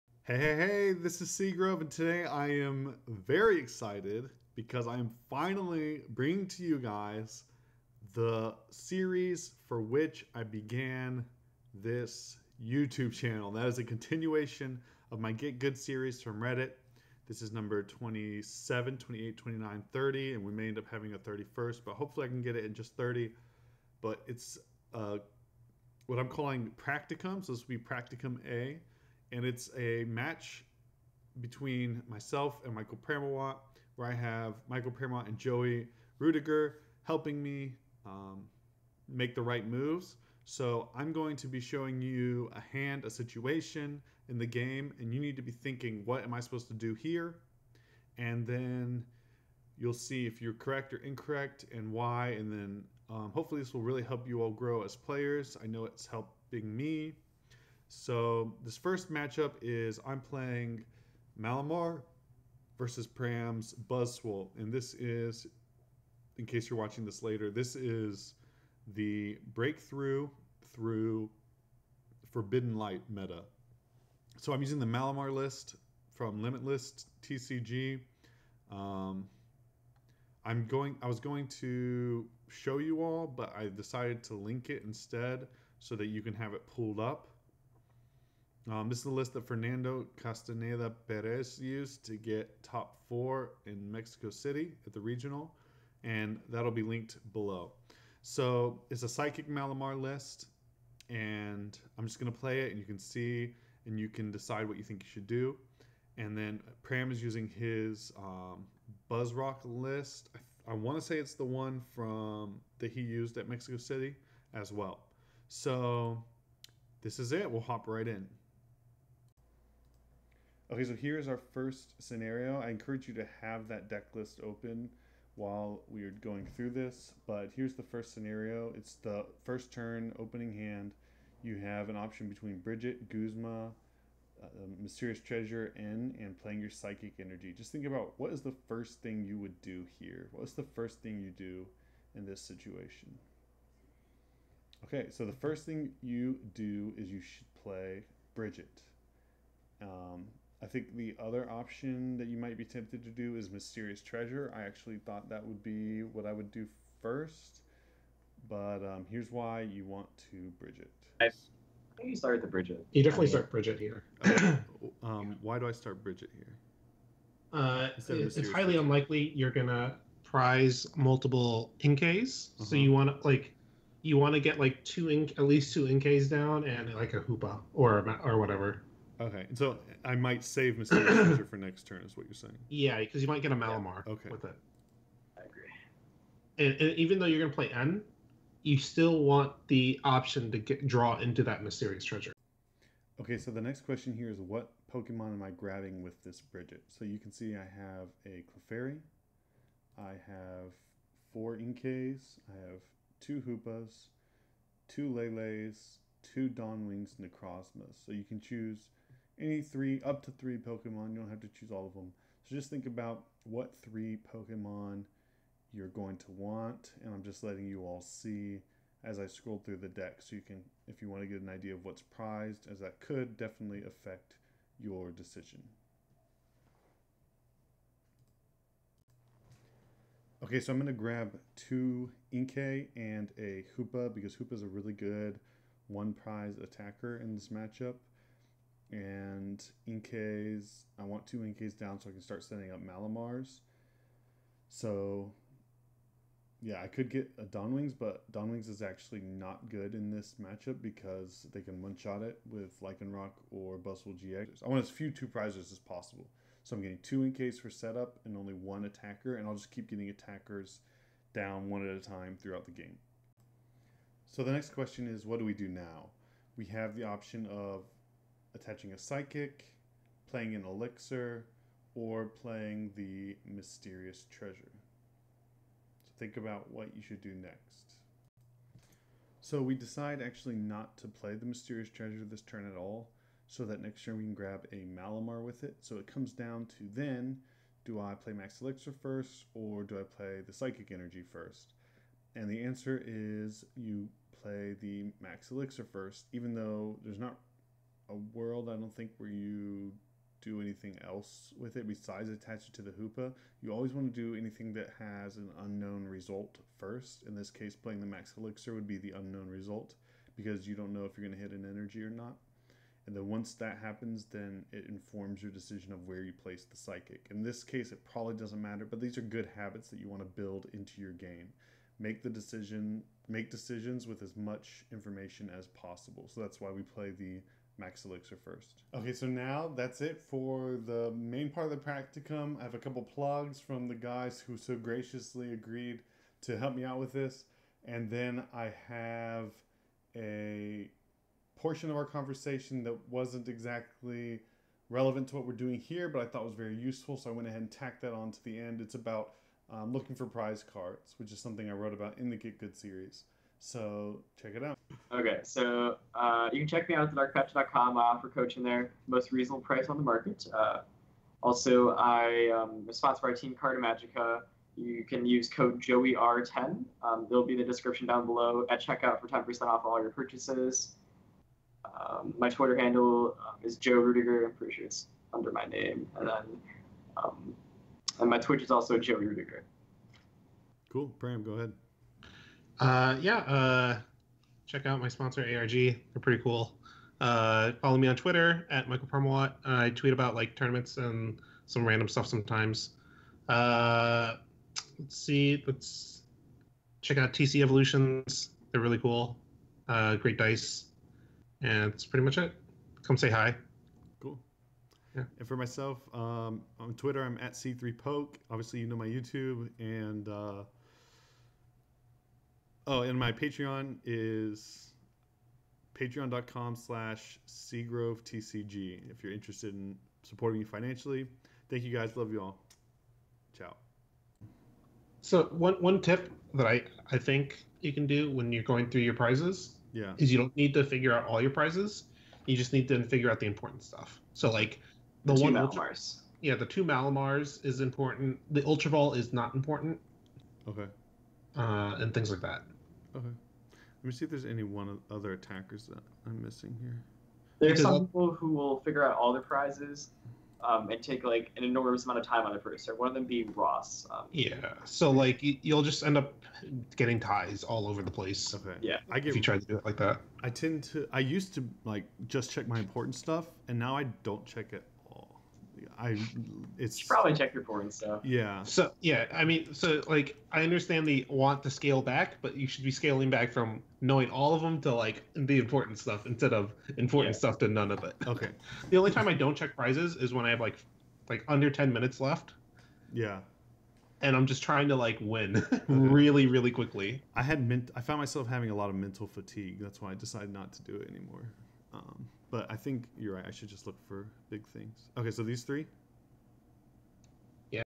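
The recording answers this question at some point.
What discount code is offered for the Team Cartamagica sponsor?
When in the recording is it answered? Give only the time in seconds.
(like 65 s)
365 s.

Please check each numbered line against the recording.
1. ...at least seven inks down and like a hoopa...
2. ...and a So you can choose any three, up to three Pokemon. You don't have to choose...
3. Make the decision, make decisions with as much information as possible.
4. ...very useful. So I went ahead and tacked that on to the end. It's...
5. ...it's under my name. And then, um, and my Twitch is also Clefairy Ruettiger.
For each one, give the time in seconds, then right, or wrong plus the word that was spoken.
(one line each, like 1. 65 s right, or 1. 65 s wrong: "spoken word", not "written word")
1. 175 s wrong: "two", not "seven"
2. 207 s right
3. 321 s right
4. 346 s right
5. 374 s wrong: "Joe", not "Clefairy".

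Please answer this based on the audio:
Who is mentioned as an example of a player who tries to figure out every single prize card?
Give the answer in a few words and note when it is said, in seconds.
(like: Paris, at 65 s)
Ross, at 453 s.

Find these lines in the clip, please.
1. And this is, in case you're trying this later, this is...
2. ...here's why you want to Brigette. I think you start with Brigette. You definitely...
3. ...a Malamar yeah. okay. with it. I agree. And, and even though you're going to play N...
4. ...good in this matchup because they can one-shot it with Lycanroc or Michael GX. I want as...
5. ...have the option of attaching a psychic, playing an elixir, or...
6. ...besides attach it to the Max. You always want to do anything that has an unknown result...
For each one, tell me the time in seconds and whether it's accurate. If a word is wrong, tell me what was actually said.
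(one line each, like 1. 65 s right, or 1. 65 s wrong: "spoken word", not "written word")
1. 64 s wrong: "watching", not "trying"
2. 159 s right
3. 183 s right
4. 249 s wrong: "Buzzwole", not "Michael"
5. 266 s right
6. 301 s wrong: "Hoopa", not "Max".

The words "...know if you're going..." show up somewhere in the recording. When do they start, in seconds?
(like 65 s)
310 s.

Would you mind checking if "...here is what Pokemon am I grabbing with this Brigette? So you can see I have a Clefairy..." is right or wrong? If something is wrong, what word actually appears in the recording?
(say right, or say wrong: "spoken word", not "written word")
right.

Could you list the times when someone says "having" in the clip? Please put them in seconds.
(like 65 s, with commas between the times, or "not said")
20 s, 488 s.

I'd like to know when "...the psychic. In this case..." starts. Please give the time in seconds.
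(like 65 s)
316 s.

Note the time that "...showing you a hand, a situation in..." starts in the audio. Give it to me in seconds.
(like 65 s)
41 s.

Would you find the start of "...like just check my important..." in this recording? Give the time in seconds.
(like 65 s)
461 s.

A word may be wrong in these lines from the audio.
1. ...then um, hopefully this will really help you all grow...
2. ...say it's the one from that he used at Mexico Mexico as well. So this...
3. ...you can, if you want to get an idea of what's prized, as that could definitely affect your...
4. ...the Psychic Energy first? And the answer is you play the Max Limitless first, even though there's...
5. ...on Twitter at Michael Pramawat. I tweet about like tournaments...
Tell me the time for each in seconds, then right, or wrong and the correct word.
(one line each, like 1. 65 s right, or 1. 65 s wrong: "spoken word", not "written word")
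1. 52 s right
2. 111 s wrong: "City", not "Mexico"
3. 220 s right
4. 290 s wrong: "Elixir", not "Limitless"
5. 388 s right.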